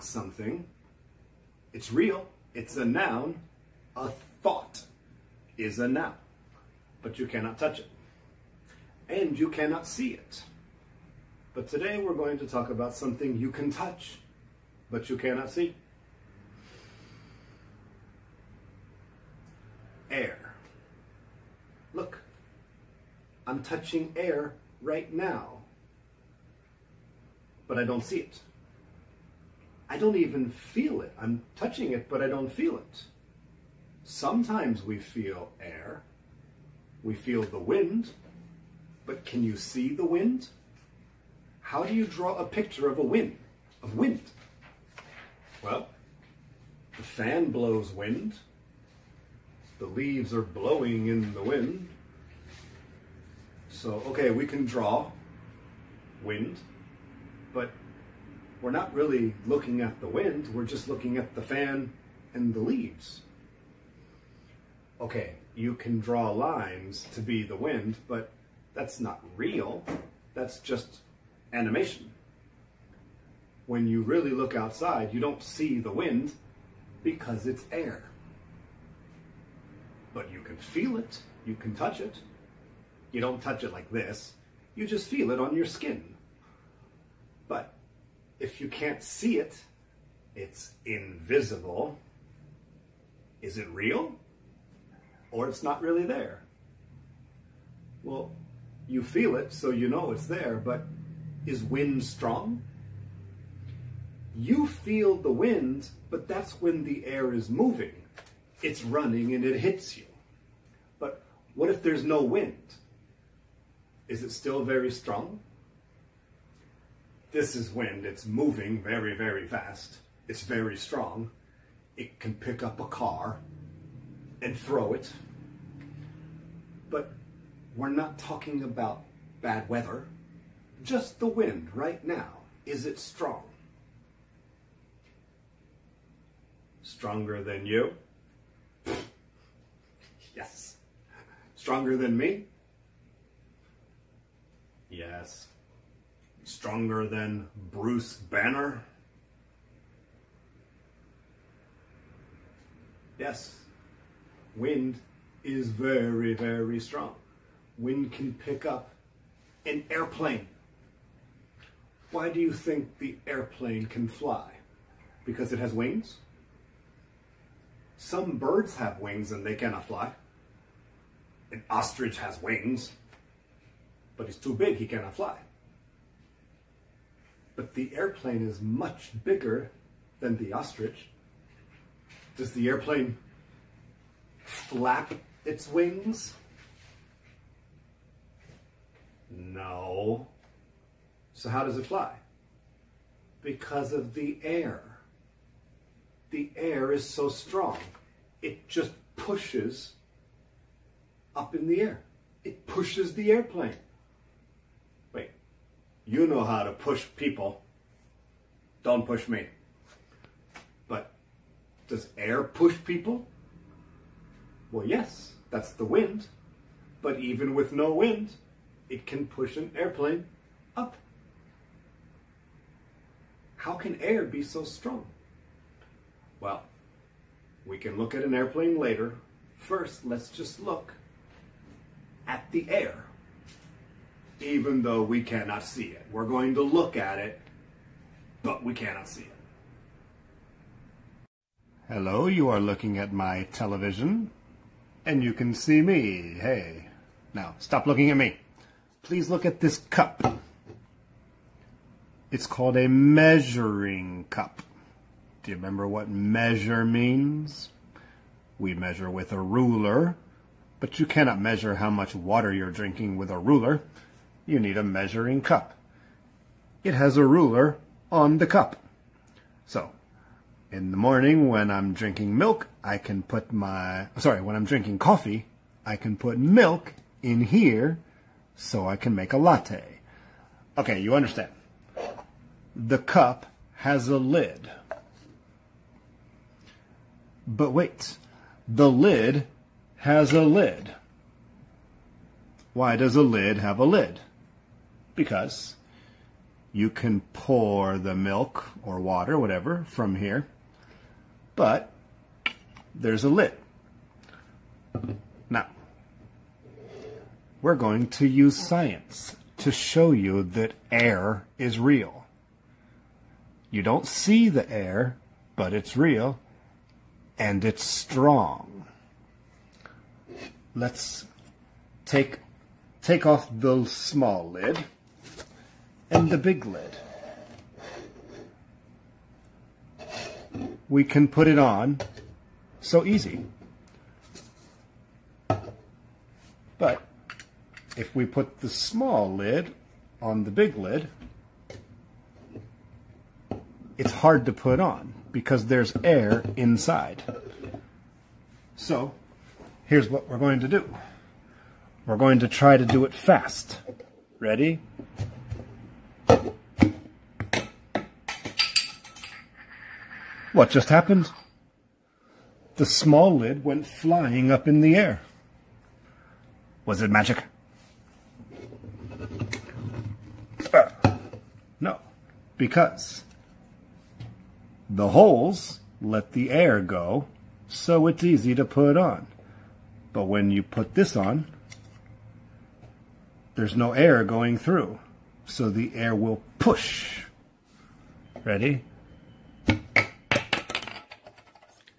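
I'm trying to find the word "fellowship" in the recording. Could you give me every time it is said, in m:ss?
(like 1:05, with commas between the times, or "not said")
not said.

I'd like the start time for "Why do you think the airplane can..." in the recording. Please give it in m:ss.
2:42.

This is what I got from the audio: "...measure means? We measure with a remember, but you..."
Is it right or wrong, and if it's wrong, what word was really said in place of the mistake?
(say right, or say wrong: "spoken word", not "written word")
wrong: "ruler", not "remember".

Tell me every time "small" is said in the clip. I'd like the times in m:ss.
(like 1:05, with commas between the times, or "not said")
5:23, 5:38, 6:02.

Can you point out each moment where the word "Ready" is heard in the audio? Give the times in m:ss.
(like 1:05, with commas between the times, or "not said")
5:54, 6:28.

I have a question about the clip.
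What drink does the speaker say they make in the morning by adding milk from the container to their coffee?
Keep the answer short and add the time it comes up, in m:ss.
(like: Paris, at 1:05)
latte, at 4:39.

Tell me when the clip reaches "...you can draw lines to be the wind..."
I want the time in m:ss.
1:05.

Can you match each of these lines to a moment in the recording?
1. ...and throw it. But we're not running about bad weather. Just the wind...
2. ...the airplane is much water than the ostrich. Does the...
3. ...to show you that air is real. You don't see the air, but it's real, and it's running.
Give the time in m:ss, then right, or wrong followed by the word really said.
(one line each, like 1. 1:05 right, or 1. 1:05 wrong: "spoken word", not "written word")
1. 2:04 wrong: "talking", not "running"
2. 2:57 wrong: "bigger", not "water"
3. 5:09 wrong: "strong", not "running".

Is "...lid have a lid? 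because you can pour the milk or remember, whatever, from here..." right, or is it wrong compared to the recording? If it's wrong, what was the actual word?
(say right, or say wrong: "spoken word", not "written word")
wrong: "water", not "remember".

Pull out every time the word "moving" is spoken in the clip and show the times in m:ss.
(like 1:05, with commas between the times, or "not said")
1:47, 1:58.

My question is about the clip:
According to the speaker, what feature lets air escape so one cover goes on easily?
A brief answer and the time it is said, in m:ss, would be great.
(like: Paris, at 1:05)
the holes, at 6:14.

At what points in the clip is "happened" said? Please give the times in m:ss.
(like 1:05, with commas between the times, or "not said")
6:00.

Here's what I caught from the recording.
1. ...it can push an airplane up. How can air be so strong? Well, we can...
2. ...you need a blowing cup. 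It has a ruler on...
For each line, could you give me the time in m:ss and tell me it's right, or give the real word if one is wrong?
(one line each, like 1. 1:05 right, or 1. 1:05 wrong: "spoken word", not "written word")
1. 3:38 right
2. 4:24 wrong: "measuring", not "blowing".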